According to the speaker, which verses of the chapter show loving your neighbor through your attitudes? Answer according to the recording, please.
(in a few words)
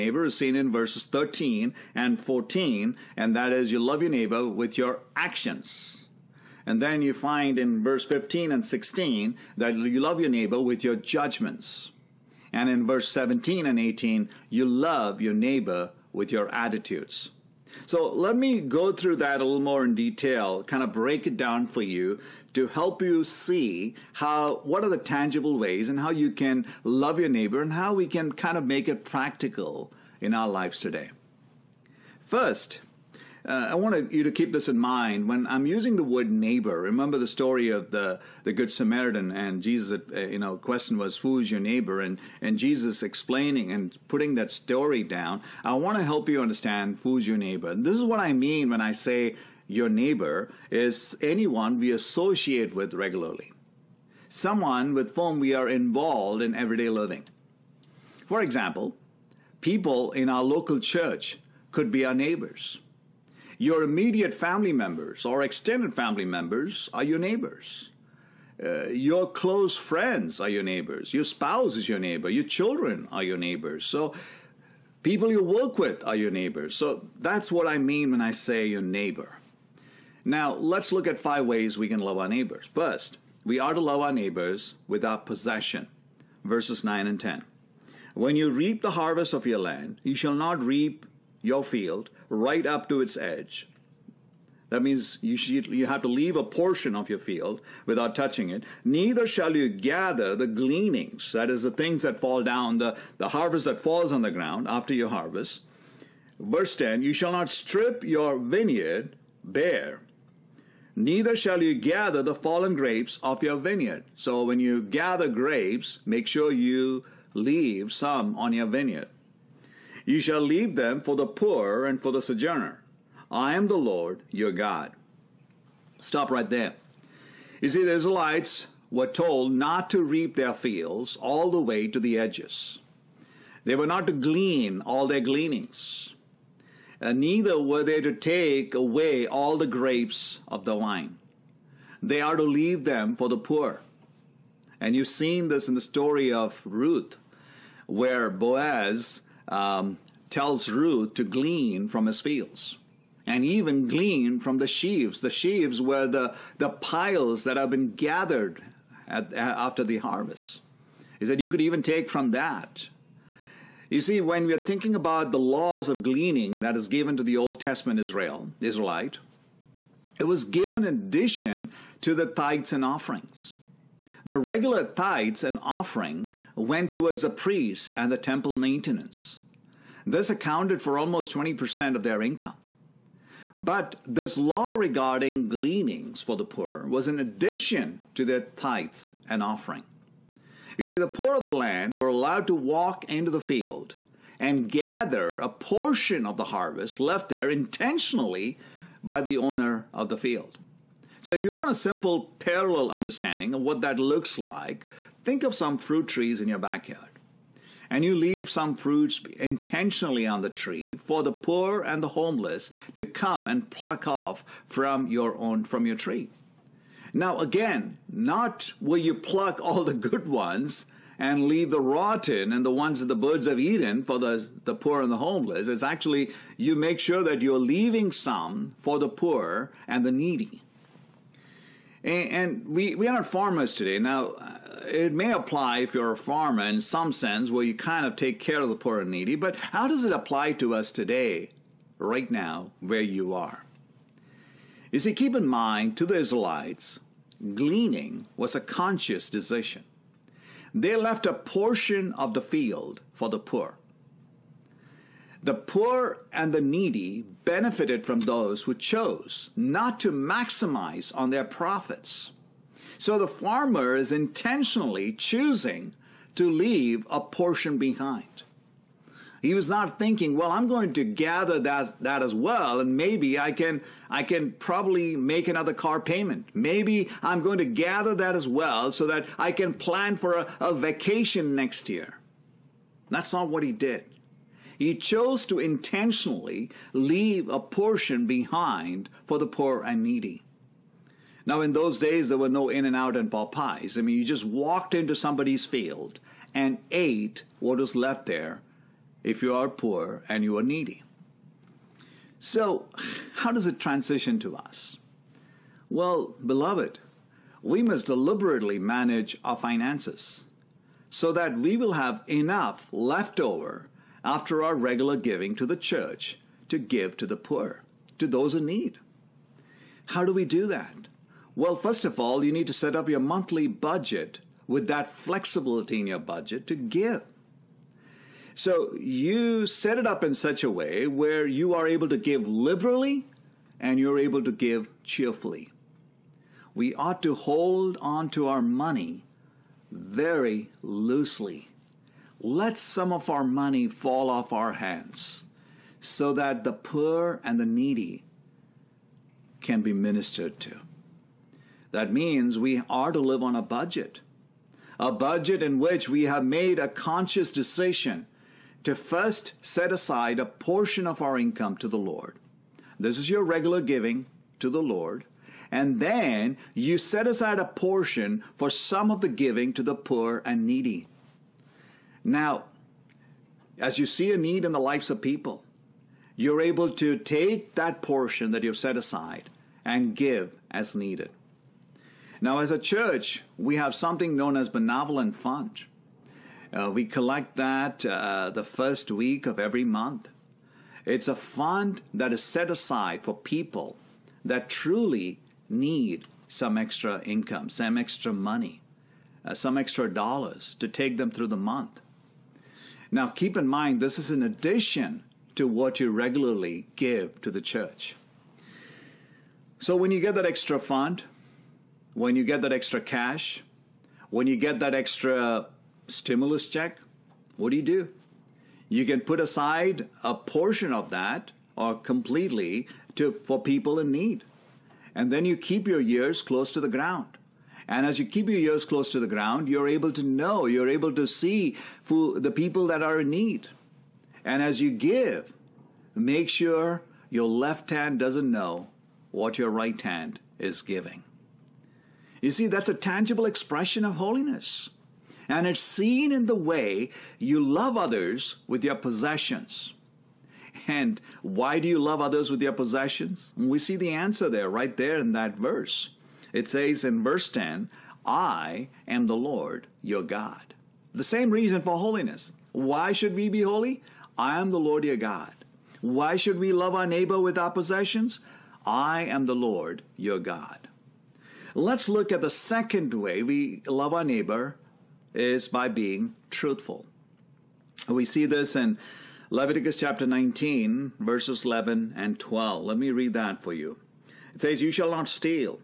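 17 and 18.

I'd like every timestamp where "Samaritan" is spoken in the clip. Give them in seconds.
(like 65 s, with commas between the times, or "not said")
38 s.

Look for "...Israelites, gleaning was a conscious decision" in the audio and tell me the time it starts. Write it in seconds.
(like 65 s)
246 s.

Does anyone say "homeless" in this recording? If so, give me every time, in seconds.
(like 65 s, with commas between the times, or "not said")
212 s, 225 s.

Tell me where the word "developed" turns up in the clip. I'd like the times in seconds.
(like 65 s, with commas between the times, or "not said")
not said.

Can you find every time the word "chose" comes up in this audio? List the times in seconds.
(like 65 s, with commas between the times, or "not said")
258 s, 284 s.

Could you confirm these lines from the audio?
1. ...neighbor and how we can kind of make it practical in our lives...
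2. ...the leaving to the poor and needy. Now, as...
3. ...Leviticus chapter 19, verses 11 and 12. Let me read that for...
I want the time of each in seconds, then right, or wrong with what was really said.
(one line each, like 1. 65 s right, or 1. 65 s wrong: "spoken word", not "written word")
1. 27 s right
2. 369 s wrong: "giving", not "leaving"
3. 479 s right.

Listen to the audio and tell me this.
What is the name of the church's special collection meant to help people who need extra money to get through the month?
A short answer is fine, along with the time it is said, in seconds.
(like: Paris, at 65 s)
benevolent fund, at 384 s.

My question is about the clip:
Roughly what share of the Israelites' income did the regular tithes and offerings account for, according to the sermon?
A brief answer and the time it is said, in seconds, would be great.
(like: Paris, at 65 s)
20%, at 181 s.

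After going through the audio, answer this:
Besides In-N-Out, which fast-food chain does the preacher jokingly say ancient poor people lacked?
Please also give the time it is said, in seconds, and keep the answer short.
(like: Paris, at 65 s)
Popeyes, at 293 s.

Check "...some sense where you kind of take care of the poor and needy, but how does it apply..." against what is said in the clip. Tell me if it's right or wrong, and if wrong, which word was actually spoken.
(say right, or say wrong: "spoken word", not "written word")
right.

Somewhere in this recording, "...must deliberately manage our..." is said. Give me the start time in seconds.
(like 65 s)
307 s.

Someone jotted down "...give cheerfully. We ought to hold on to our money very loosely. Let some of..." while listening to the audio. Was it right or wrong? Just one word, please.
right.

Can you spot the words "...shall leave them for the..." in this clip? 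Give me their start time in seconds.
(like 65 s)
120 s.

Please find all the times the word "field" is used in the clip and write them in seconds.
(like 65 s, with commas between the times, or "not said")
91 s, 97 s, 130 s, 152 s, 193 s, 200 s, 252 s, 295 s.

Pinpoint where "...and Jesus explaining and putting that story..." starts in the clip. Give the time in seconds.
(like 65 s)
42 s.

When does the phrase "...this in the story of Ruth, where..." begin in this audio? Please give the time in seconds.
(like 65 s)
145 s.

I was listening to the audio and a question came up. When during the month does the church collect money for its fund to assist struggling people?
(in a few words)
first week.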